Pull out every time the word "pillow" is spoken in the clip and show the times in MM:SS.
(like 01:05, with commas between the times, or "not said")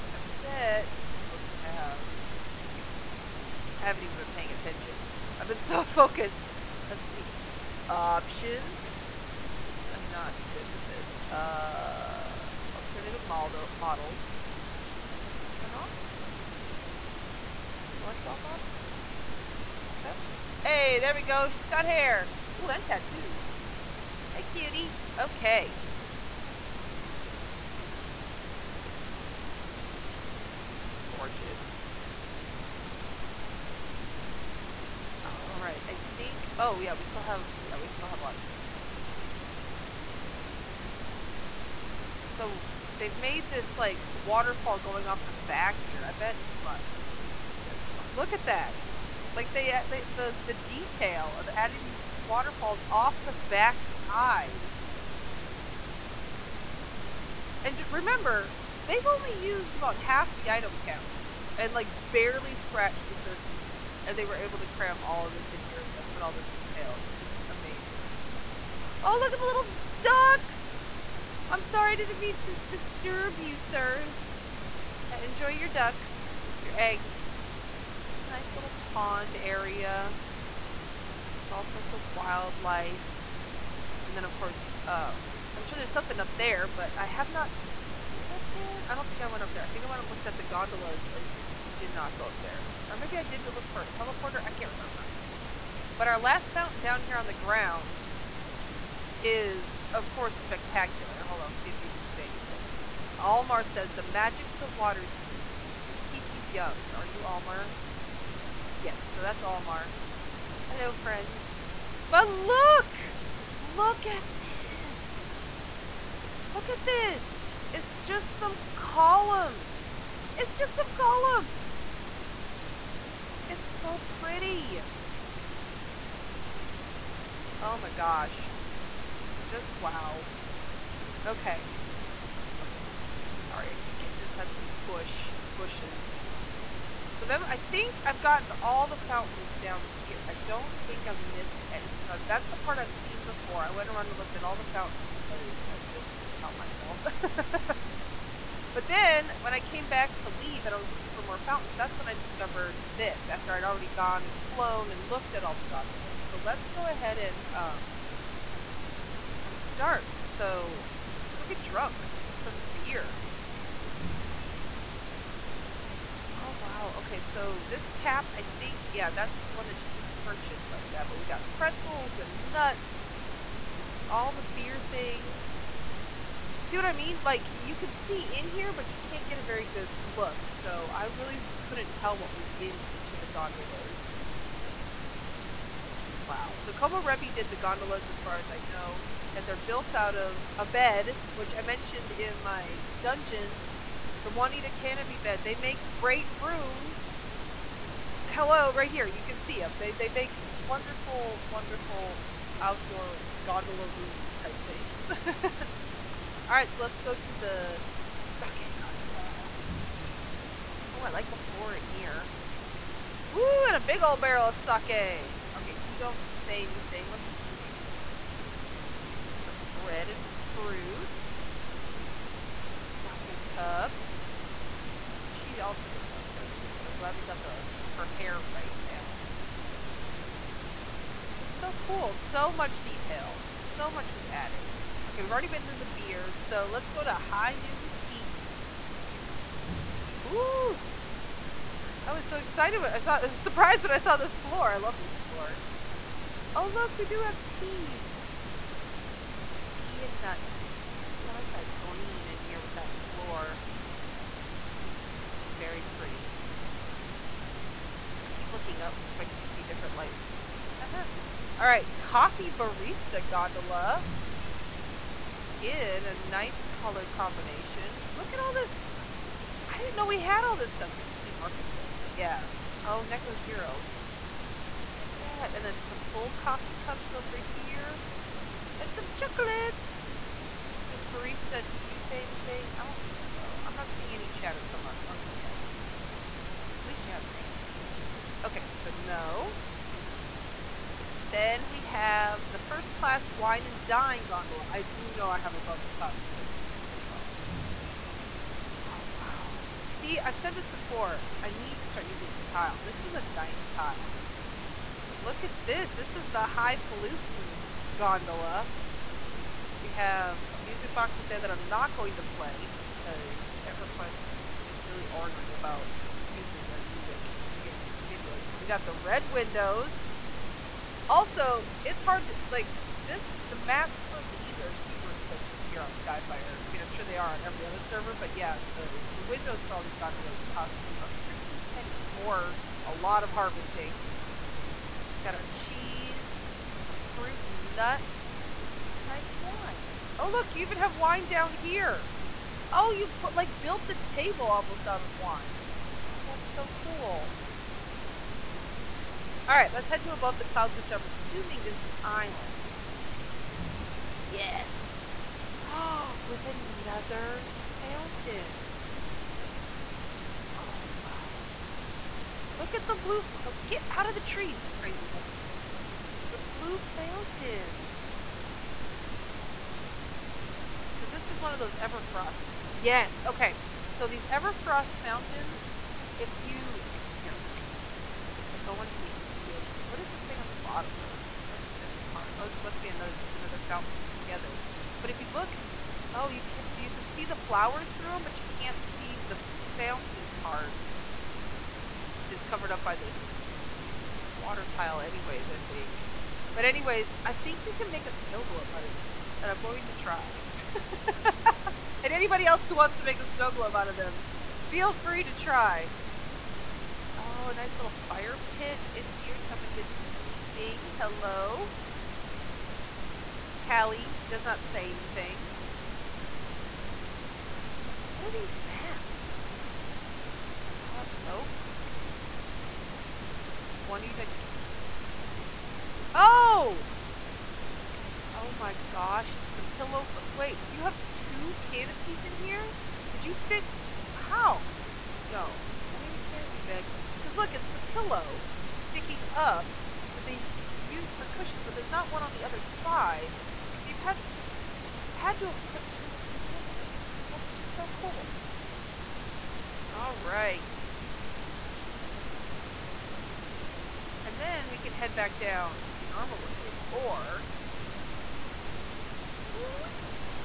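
07:09, 07:17.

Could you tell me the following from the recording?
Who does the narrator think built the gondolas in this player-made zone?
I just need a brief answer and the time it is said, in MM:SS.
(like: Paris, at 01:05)
Komorebi, at 03:06.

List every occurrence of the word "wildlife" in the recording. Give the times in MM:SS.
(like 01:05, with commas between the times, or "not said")
01:22.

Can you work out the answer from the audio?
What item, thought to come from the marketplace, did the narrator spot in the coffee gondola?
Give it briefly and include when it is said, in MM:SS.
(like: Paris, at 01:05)
Neko Zero, at 04:33.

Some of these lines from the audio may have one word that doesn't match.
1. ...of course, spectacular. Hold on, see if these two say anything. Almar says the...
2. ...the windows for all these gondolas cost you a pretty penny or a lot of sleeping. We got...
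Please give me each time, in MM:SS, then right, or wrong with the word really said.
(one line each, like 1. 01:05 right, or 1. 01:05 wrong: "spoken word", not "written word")
1. 01:39 right
2. 05:29 wrong: "harvesting", not "sleeping".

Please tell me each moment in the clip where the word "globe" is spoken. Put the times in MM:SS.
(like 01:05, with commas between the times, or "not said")
06:38, 06:43.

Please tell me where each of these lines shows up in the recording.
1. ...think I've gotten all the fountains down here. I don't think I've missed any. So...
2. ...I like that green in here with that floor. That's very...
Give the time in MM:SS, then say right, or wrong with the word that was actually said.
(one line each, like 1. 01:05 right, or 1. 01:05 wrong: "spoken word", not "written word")
1. 02:17 right
2. 04:11 right.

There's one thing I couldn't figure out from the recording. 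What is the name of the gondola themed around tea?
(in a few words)
High Noon Tea.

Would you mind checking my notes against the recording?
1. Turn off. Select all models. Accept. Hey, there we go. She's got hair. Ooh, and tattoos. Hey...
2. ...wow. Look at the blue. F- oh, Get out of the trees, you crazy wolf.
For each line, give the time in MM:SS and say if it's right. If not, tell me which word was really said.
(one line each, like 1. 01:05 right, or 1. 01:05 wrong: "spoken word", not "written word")
1. 00:15 right
2. 06:00 right.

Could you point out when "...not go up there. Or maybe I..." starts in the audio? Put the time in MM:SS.
01:31.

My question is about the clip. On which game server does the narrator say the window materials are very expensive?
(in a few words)
Skyfire.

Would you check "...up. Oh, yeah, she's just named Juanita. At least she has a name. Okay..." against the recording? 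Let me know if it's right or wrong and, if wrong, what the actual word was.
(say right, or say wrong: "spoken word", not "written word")
wrong: "Barista", not "Juanita".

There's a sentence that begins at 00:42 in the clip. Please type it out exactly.
So they've made this like waterfall going off the back here.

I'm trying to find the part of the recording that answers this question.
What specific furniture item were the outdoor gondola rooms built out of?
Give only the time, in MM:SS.
03:14.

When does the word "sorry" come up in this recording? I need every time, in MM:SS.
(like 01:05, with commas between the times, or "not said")
01:11, 02:13.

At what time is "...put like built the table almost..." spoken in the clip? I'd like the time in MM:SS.
05:43.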